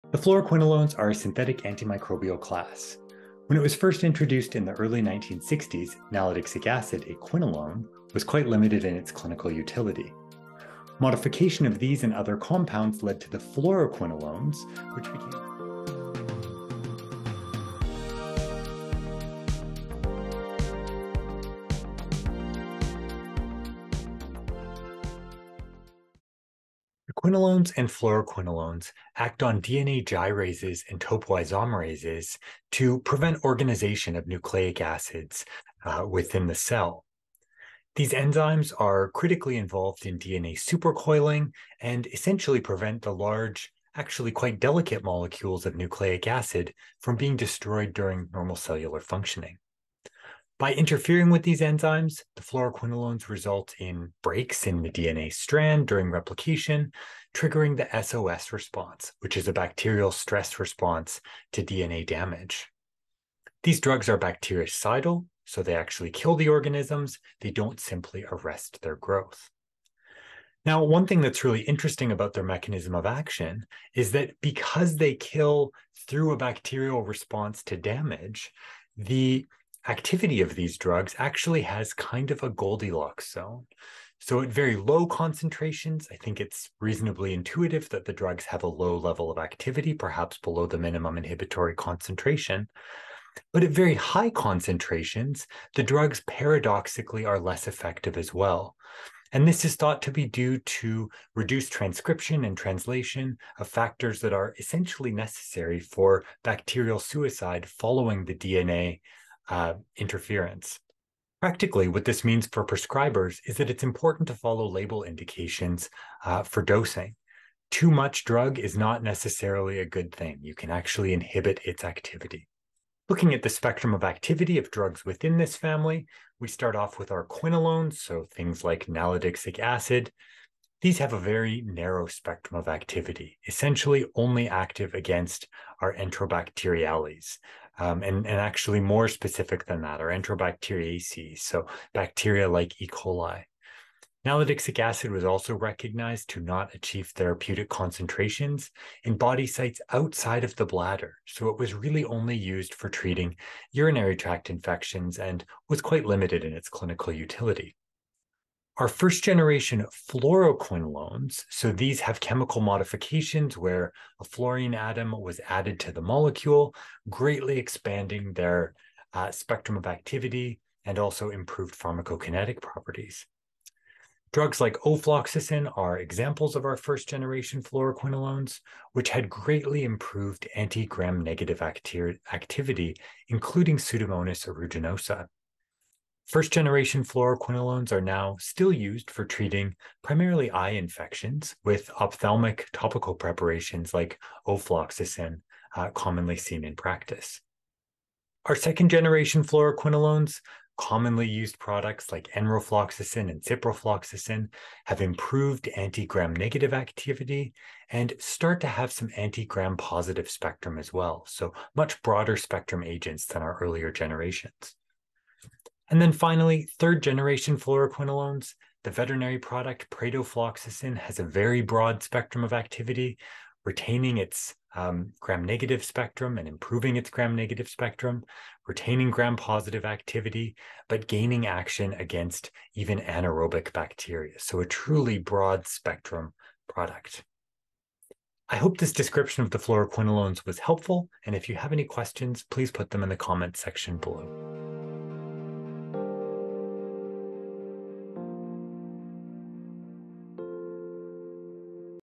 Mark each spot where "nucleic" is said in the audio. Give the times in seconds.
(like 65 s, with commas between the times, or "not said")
34 s, 45 s.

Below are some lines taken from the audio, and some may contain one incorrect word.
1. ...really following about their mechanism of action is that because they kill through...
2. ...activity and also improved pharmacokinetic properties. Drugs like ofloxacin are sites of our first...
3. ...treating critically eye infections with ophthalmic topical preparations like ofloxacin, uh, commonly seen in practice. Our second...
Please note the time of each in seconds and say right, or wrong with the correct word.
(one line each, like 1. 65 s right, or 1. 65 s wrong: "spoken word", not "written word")
1. 71 s wrong: "interesting", not "following"
2. 169 s wrong: "examples", not "sites"
3. 189 s wrong: "primarily", not "critically".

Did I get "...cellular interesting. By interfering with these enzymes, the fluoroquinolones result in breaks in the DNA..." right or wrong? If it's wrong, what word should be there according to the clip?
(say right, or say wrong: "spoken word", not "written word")
wrong: "functioning", not "interesting".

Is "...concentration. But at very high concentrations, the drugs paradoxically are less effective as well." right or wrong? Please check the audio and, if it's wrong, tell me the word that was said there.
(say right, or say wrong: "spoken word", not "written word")
right.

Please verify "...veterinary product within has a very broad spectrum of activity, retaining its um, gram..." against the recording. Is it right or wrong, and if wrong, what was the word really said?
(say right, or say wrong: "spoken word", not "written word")
wrong: "pradofloxacin", not "within".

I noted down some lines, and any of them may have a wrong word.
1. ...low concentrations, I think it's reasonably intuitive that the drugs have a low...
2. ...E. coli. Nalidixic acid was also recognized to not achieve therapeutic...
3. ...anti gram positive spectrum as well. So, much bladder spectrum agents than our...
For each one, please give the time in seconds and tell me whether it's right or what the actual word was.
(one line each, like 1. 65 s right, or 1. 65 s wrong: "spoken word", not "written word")
1. 84 s right
2. 142 s right
3. 209 s wrong: "broader", not "bladder".